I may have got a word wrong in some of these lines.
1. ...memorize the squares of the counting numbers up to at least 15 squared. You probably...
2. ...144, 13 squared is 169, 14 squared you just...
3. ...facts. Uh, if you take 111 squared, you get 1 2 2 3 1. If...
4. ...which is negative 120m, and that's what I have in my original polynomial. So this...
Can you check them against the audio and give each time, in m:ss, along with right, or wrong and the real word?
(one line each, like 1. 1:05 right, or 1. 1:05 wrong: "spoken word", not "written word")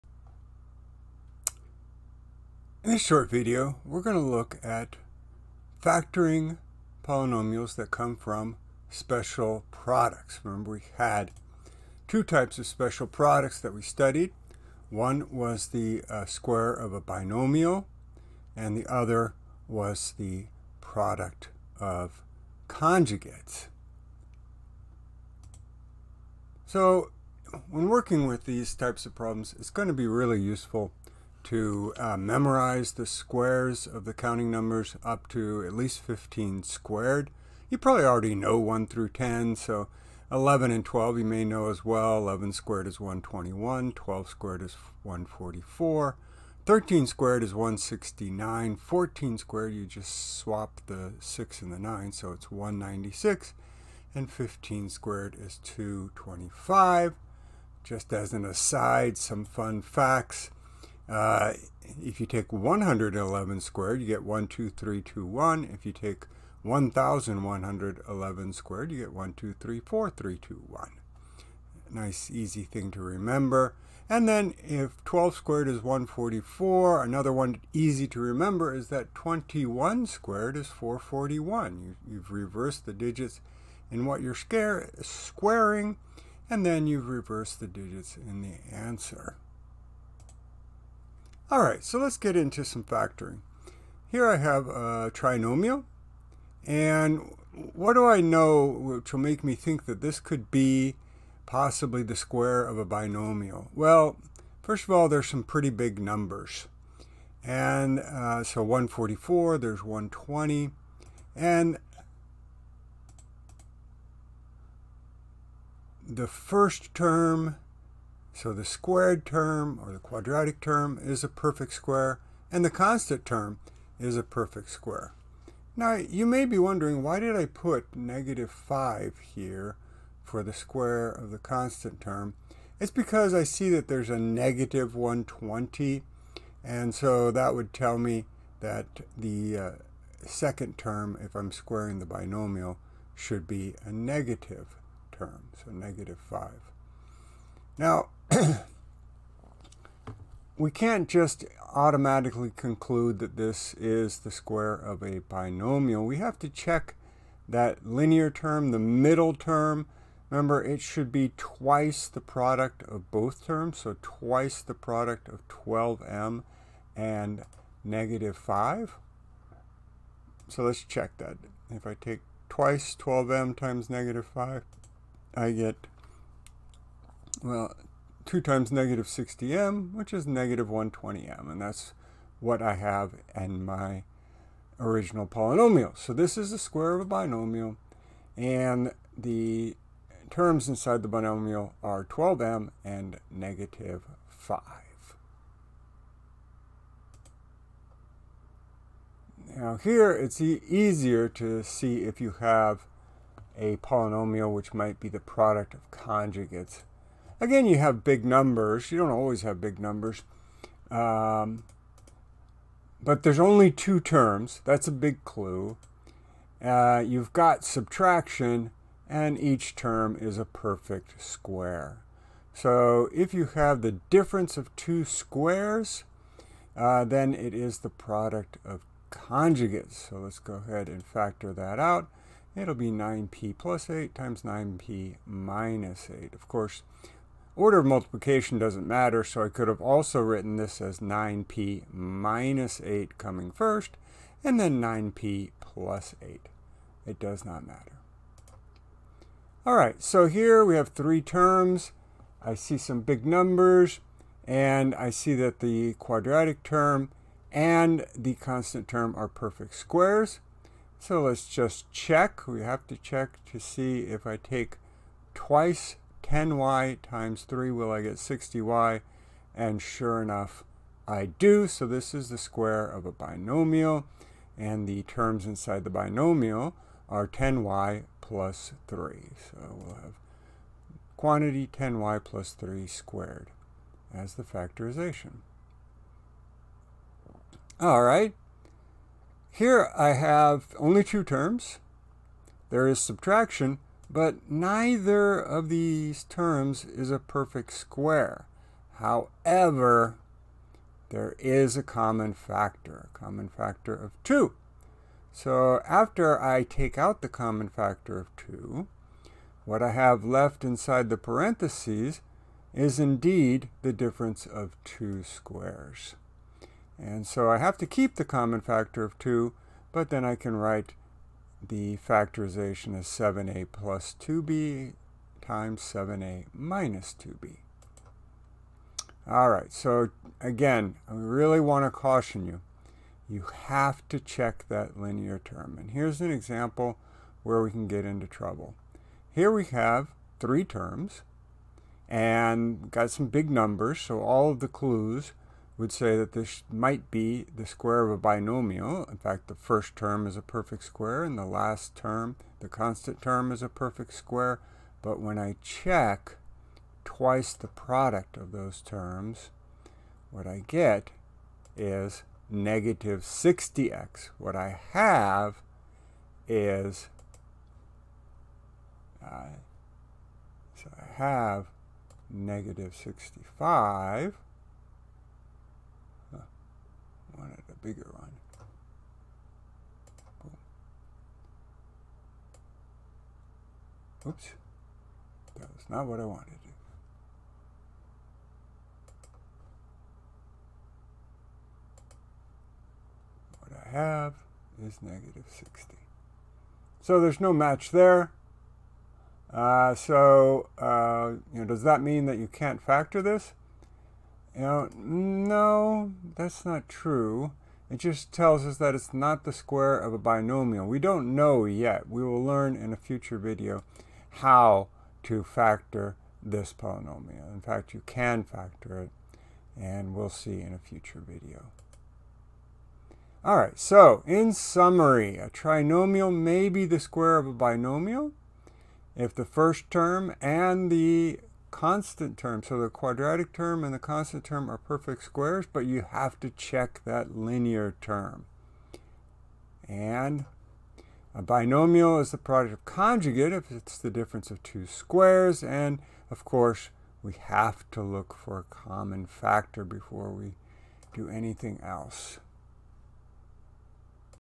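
1. 0:32 right
2. 0:45 right
3. 0:59 right
4. 2:59 right.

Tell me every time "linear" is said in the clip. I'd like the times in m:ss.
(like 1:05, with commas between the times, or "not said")
2:37, 5:34, 7:17.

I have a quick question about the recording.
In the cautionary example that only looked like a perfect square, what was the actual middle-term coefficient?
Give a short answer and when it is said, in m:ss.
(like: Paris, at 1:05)
-65, at 6:12.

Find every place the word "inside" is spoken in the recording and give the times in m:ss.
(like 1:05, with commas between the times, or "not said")
3:10, 4:35, 5:10.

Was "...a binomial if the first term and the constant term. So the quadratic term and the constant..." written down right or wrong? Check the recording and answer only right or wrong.
right.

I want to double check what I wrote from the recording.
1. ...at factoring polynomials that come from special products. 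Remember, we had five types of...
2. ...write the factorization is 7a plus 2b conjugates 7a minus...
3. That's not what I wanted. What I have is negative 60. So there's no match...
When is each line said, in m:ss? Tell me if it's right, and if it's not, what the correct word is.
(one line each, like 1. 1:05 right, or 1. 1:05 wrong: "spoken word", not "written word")
1. 0:04 wrong: "two", not "five"
2. 5:20 wrong: "times", not "conjugates"
3. 6:25 right.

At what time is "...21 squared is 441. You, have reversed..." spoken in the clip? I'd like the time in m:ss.
1:19.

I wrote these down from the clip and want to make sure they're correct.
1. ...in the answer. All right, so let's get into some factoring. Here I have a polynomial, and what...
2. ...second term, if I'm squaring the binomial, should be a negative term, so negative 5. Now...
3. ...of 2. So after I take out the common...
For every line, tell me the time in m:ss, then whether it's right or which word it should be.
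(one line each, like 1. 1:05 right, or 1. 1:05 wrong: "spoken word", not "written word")
1. 1:28 wrong: "trinomial", not "polynomial"
2. 2:20 right
3. 5:03 right.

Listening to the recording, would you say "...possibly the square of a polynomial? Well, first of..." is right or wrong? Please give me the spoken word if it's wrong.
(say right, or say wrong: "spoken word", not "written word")
wrong: "binomial", not "polynomial".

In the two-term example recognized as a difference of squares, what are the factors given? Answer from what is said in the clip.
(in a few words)
9p + 8 and 9p - 8.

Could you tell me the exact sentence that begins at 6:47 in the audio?
It just tells us that it's not the square of a binomial.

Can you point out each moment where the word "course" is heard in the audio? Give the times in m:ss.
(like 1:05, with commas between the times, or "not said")
3:56, 7:26.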